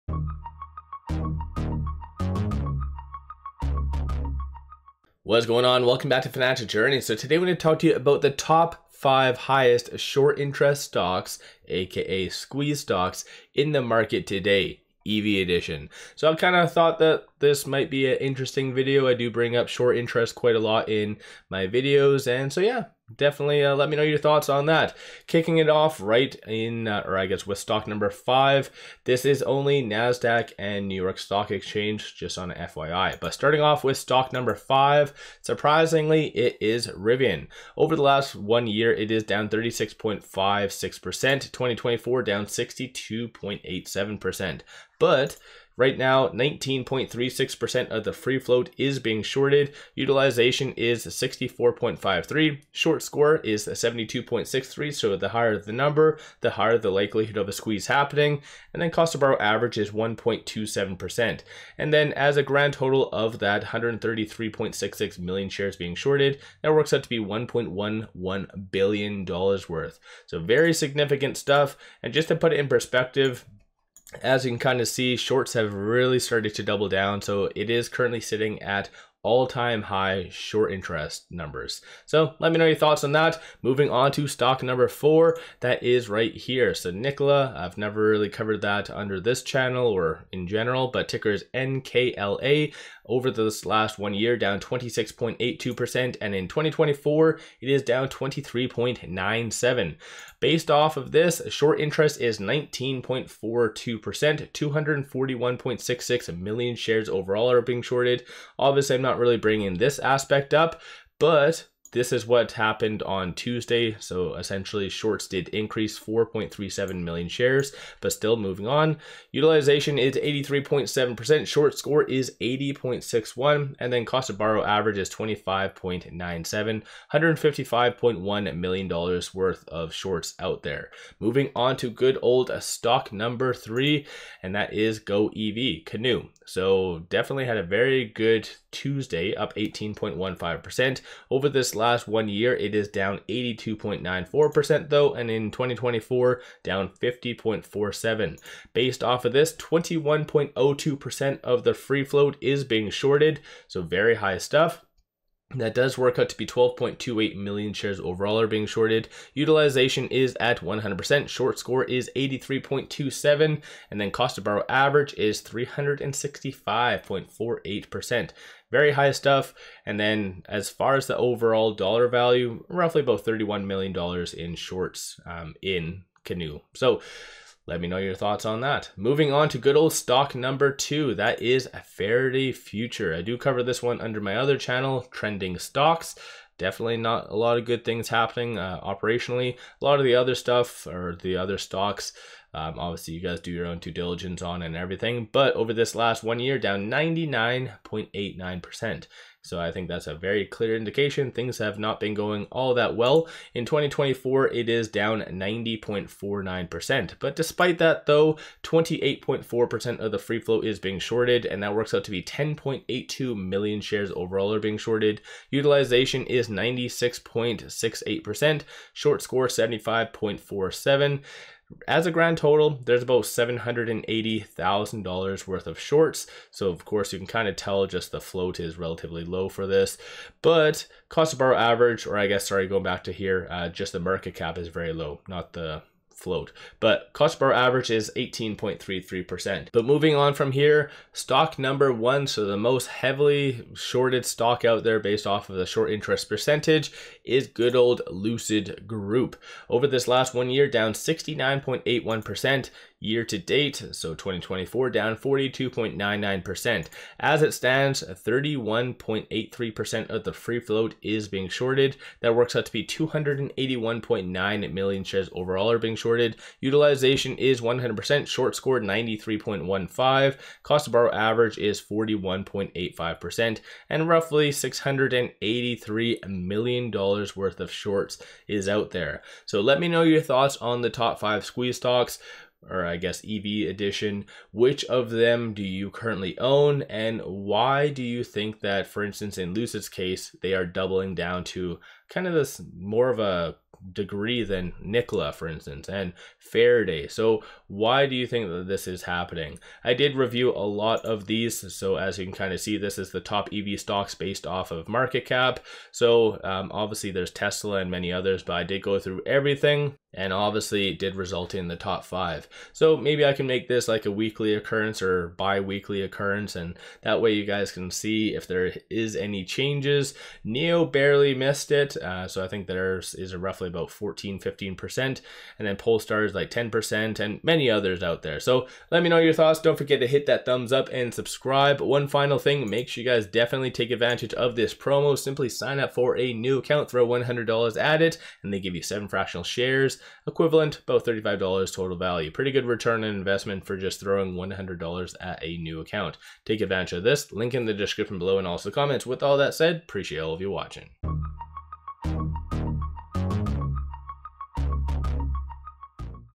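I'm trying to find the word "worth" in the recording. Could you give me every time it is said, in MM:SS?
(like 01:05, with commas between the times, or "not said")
01:09, 02:09, 03:45, 04:36.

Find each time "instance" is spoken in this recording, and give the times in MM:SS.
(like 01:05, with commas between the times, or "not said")
04:49, 04:55.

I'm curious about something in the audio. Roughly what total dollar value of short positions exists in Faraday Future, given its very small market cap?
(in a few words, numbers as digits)
$780,000.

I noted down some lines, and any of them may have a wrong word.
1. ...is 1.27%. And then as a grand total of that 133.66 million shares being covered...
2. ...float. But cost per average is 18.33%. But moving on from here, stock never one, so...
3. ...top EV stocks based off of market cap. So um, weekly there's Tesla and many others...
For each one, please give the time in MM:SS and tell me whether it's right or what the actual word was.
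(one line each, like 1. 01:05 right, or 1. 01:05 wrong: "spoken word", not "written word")
1. 00:59 wrong: "shorted", not "covered"
2. 03:56 wrong: "number", not "never"
3. 05:03 wrong: "obviously", not "weekly".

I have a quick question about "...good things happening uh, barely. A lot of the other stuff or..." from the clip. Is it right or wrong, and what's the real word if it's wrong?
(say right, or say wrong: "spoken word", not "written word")
wrong: "operationally", not "barely".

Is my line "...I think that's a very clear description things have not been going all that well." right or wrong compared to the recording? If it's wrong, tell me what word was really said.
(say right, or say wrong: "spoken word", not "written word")
wrong: "indication", not "description".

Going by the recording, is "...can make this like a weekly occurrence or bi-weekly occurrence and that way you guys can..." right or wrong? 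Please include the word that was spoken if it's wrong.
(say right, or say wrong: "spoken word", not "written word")
right.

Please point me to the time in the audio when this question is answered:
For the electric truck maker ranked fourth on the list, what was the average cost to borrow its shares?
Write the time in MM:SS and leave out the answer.
02:05.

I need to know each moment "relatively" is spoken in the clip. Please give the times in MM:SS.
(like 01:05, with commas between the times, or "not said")
03:48.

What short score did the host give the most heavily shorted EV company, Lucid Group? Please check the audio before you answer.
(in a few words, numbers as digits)
93.15.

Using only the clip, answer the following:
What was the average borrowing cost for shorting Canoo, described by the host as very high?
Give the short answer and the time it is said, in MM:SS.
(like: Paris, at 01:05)
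365.48%, at 02:45.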